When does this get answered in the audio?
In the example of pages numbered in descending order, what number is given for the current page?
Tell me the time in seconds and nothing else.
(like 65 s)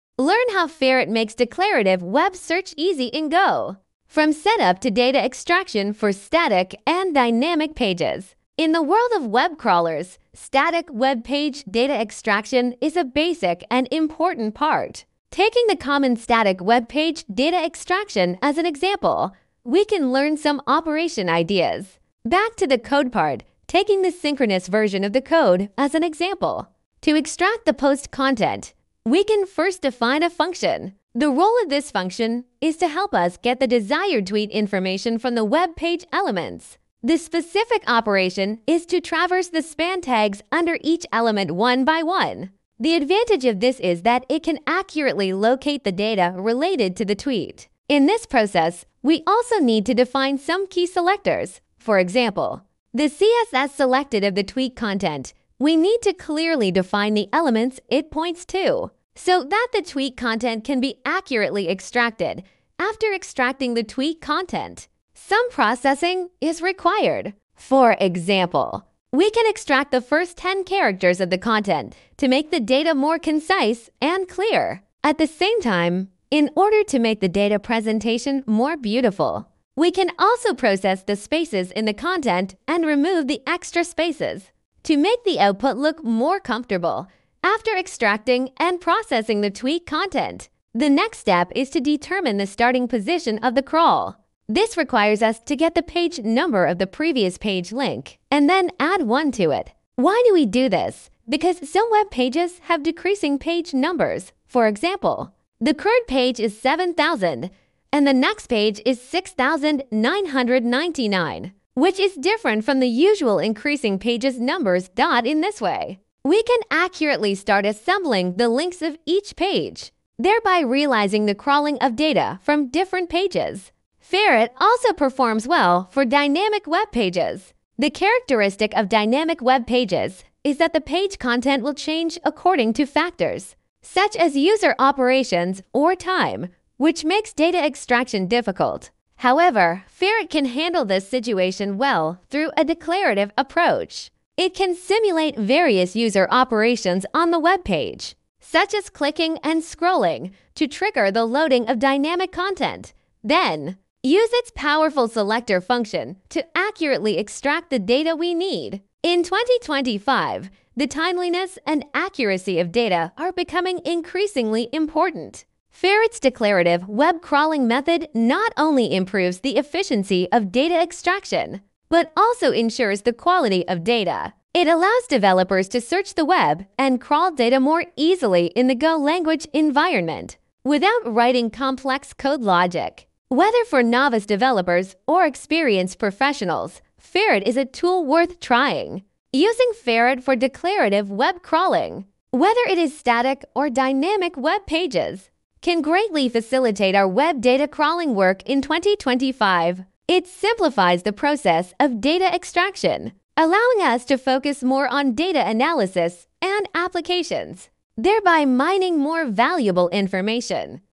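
106 s.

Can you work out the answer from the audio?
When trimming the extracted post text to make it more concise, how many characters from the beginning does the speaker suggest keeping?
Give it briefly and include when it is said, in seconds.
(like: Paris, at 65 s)
10, at 70 s.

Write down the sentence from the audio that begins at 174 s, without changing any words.
It allows developers to search the web and crawl data more easily in the Go language environment without writing complex code logic.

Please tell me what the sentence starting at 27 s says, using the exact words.
To extract the post content, we can first define a function.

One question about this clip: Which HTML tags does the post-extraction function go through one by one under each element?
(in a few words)
span.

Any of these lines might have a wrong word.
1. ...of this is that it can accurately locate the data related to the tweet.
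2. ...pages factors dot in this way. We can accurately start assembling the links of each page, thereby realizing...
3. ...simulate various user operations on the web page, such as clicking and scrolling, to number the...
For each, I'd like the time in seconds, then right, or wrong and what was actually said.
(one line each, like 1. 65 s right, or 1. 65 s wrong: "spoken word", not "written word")
1. 43 s right
2. 113 s wrong: "numbers", not "factors"
3. 144 s wrong: "trigger", not "number".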